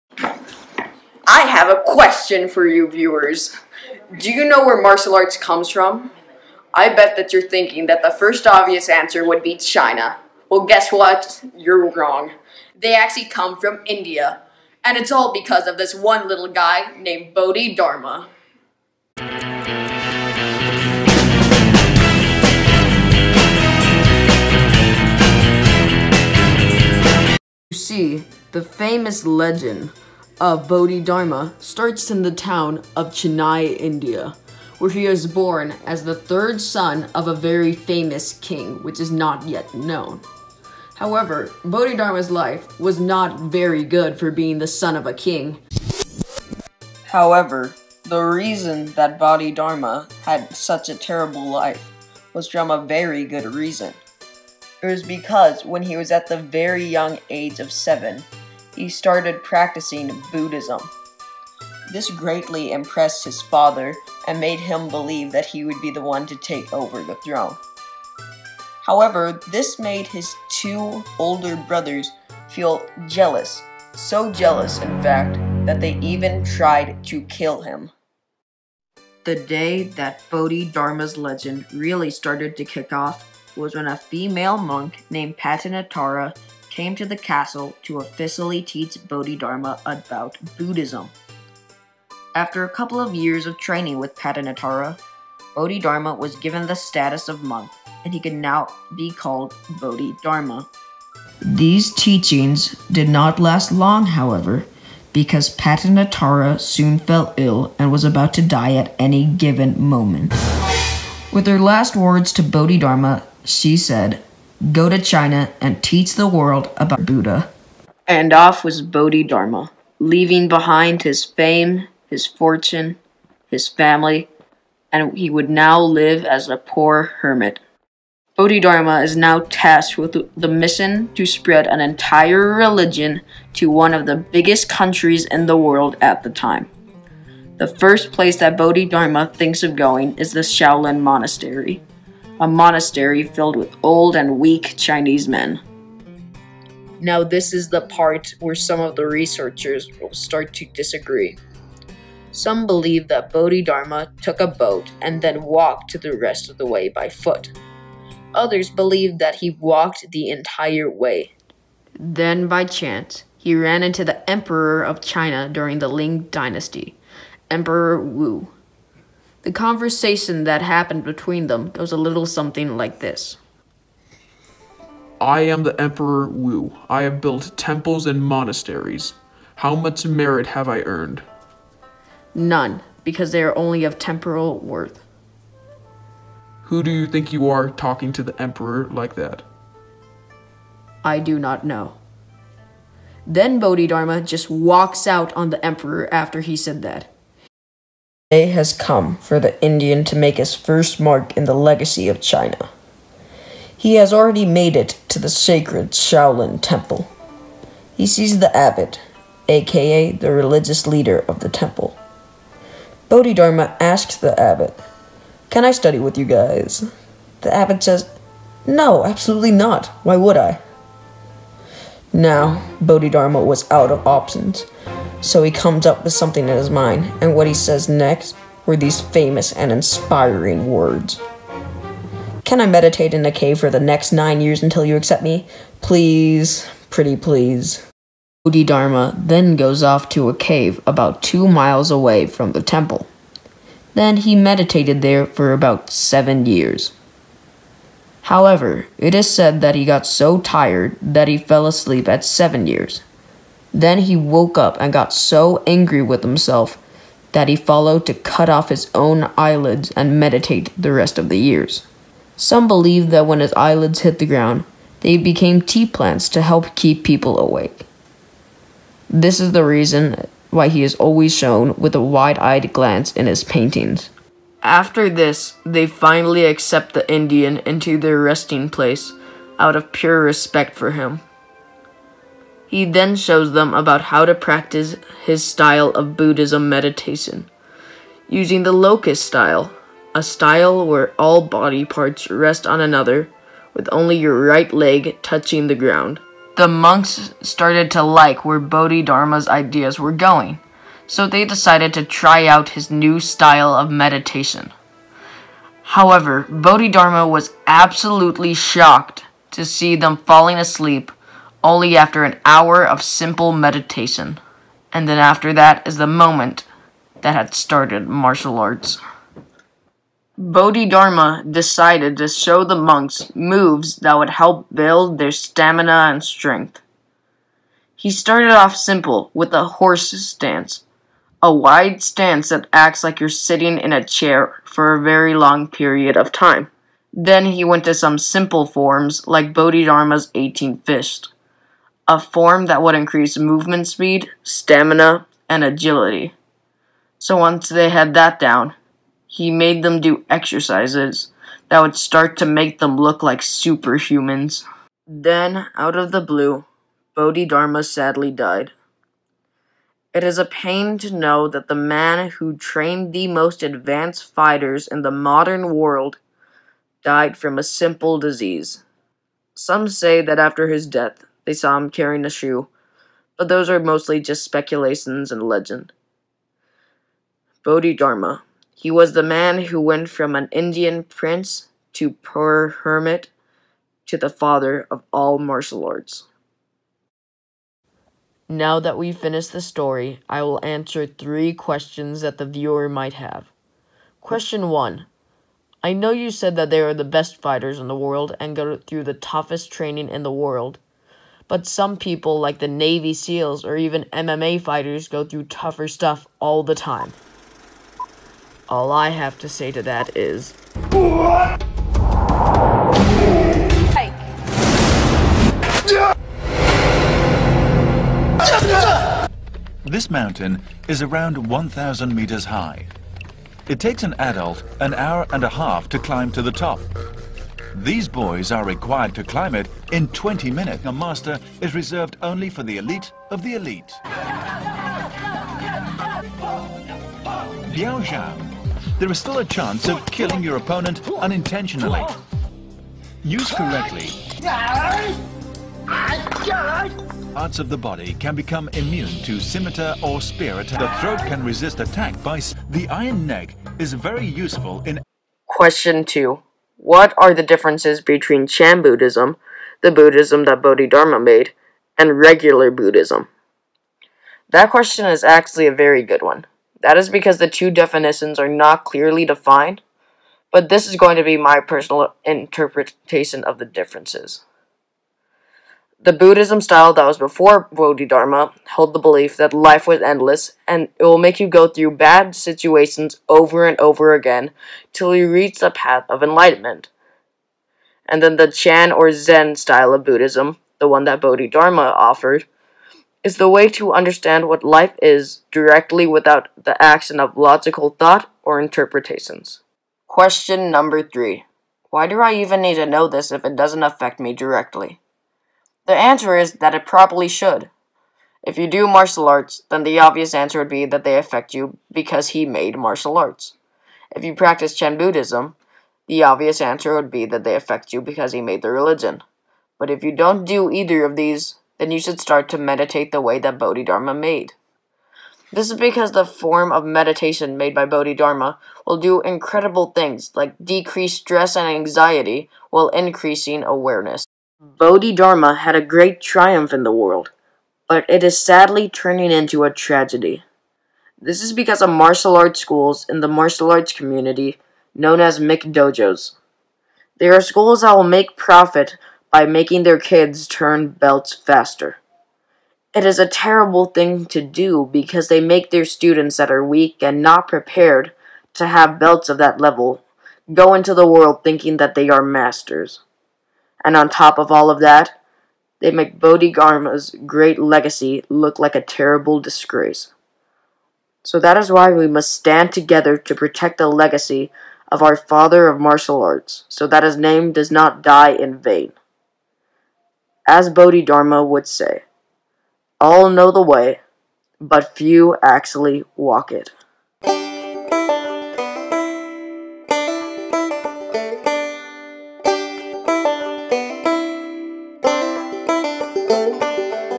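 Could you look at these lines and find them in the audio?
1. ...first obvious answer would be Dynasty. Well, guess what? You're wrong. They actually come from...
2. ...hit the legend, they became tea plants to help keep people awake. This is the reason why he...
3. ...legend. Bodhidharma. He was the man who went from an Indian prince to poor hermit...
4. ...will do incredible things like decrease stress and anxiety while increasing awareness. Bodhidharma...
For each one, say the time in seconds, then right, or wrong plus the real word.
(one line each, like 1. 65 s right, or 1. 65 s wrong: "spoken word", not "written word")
1. 8 s wrong: "China", not "Dynasty"
2. 263 s wrong: "ground", not "legend"
3. 375 s right
4. 528 s right.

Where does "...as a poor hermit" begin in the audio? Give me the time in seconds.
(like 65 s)
126 s.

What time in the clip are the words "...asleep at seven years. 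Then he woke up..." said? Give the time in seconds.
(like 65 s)
251 s.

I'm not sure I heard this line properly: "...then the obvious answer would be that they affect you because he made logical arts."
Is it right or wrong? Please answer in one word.
wrong.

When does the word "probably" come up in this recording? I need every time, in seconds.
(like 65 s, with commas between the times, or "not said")
506 s.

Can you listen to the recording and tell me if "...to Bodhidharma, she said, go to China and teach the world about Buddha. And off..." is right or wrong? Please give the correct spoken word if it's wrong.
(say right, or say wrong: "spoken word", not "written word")
right.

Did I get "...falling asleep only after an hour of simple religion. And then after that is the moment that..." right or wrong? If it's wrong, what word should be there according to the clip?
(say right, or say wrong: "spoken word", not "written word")
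wrong: "meditation", not "religion".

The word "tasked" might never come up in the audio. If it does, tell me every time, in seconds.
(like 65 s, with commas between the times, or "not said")
129 s.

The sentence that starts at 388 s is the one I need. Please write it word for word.
Now that we've finished the story, I will answer three questions that the viewer might have.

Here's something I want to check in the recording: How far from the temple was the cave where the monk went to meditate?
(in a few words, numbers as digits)
2 miles.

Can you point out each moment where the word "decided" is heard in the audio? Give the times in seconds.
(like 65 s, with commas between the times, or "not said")
301 s, 321 s.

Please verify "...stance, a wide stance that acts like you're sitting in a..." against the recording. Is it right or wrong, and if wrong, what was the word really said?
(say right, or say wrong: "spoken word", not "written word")
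right.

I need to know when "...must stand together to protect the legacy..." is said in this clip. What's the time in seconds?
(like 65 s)
572 s.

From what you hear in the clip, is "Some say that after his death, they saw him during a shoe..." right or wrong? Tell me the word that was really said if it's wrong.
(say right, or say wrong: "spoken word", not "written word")
wrong: "carrying", not "during".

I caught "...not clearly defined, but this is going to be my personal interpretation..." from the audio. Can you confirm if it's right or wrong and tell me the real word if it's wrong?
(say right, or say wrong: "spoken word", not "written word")
right.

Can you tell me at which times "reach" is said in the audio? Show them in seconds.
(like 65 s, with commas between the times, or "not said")
485 s.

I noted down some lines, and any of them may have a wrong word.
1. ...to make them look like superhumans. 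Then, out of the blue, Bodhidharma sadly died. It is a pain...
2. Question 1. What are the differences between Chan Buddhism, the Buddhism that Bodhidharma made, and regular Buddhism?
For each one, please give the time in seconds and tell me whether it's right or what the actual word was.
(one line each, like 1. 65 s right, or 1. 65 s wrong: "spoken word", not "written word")
1. 352 s right
2. 455 s wrong: "2", not "1".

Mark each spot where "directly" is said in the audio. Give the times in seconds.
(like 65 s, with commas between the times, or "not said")
495 s, 504 s.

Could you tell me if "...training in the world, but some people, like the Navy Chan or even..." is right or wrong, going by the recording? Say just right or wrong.
wrong.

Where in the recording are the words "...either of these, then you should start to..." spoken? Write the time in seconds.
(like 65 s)
520 s.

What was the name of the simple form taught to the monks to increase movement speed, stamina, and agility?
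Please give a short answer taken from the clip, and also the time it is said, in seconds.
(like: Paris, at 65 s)
Bodhidharma's 18 fist, at 339 s.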